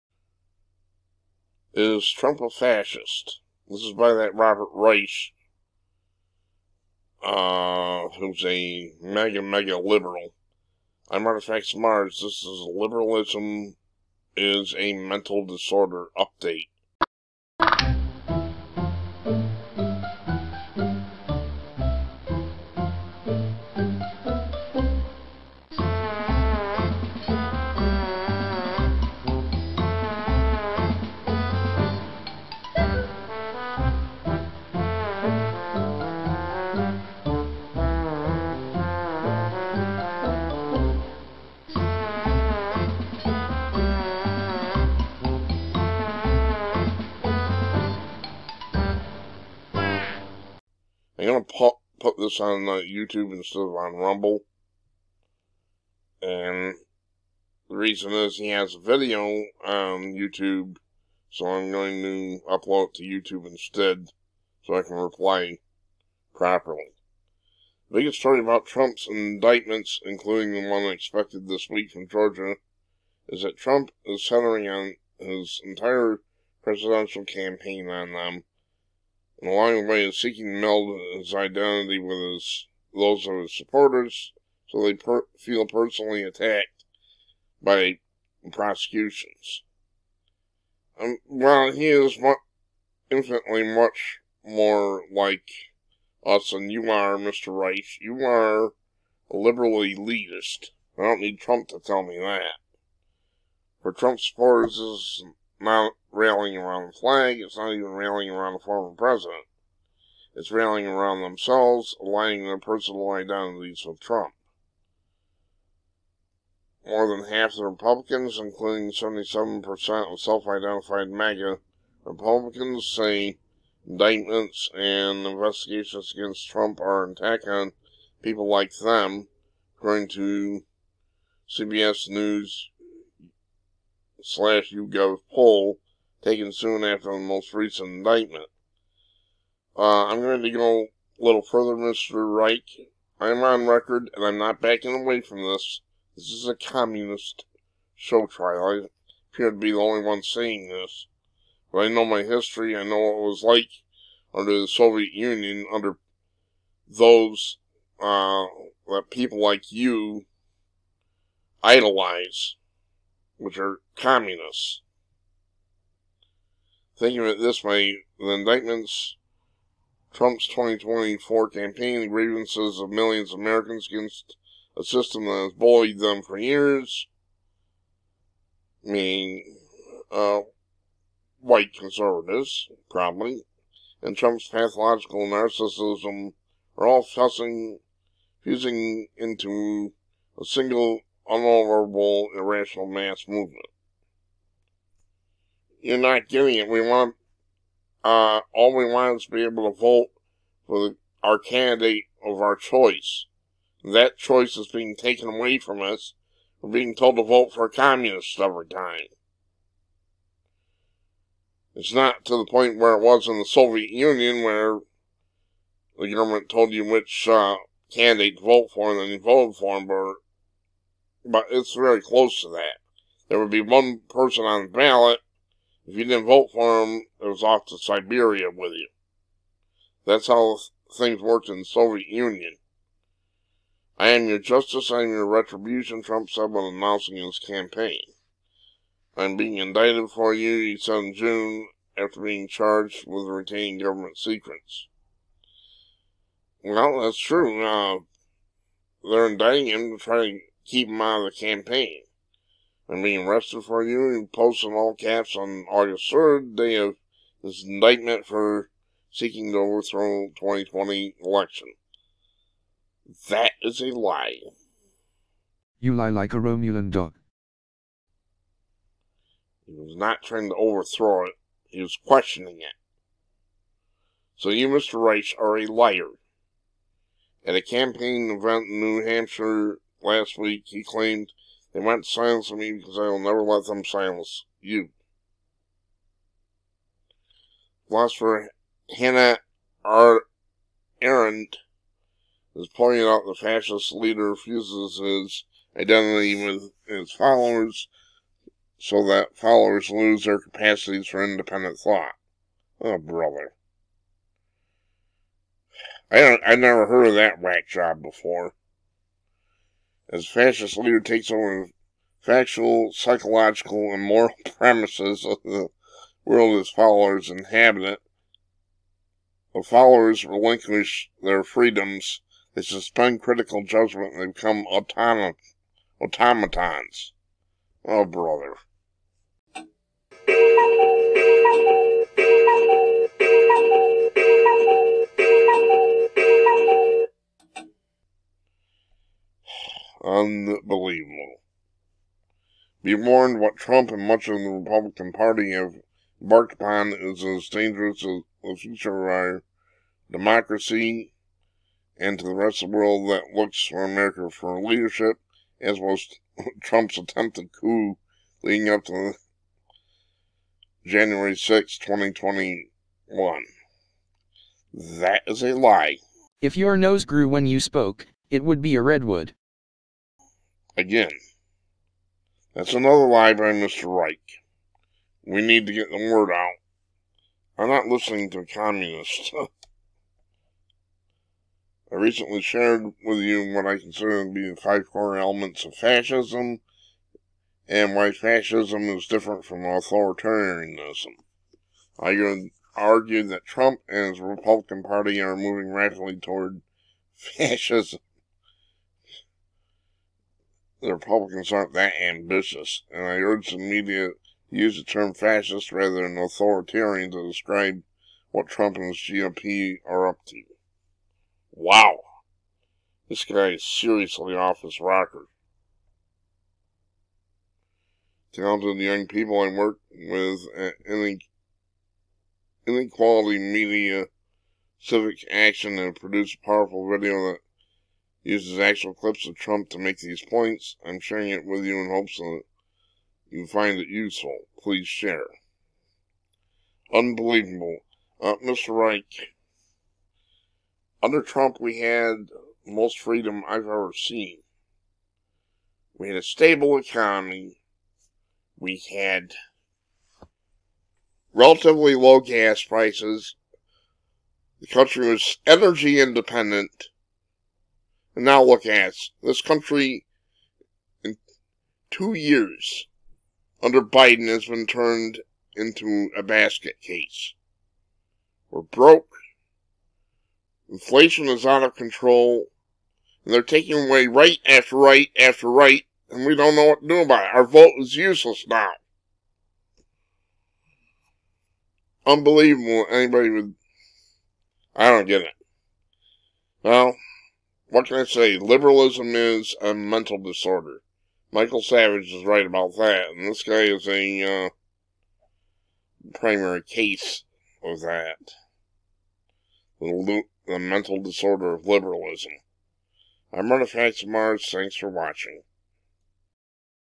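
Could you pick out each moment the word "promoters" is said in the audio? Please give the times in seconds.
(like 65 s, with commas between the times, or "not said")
not said.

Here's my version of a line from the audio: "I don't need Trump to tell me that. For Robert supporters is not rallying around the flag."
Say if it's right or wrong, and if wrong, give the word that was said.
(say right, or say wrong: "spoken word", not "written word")
wrong: "Trump", not "Robert".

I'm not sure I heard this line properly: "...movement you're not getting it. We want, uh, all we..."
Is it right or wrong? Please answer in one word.
right.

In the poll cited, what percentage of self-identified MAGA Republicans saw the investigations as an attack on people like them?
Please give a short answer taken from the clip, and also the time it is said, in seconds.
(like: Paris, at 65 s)
77%, at 118 s.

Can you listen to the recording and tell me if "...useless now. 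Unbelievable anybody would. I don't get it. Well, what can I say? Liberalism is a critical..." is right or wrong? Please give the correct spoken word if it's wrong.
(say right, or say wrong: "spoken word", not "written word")
wrong: "mental", not "critical".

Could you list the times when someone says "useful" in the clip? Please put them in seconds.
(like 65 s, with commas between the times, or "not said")
433 s.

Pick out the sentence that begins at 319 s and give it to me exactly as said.
The followers relinquish their freedoms, they suspend critical judgment, and they become automatons.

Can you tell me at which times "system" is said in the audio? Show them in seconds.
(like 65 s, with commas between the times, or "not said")
174 s.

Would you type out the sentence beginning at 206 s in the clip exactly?
We're being told to vote for a communist every time.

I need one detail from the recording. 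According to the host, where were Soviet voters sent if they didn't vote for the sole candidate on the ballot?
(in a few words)
Siberia.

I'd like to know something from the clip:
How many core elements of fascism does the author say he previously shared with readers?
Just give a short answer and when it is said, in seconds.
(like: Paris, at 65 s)
5, at 384 s.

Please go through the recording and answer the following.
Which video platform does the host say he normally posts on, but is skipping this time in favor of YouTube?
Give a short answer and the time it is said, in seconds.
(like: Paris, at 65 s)
Rumble, at 53 s.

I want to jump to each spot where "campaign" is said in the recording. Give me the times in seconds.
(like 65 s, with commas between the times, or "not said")
77 s, 171 s, 237 s, 251 s, 277 s.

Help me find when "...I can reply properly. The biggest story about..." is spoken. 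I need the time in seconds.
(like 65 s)
64 s.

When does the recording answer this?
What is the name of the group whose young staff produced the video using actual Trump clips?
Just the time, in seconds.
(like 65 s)
422 s.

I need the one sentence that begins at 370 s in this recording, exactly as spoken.
Again, that's another lie by Mr.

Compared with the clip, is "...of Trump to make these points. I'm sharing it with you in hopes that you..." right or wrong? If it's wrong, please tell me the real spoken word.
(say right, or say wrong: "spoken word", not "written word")
right.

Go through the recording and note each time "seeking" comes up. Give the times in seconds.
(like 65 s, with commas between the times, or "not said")
80 s, 259 s.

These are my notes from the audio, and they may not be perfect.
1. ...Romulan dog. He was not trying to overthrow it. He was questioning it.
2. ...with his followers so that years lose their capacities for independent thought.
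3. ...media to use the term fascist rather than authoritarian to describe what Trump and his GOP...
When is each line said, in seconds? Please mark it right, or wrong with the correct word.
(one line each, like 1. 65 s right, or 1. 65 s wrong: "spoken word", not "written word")
1. 266 s right
2. 296 s wrong: "followers", not "years"
3. 403 s right.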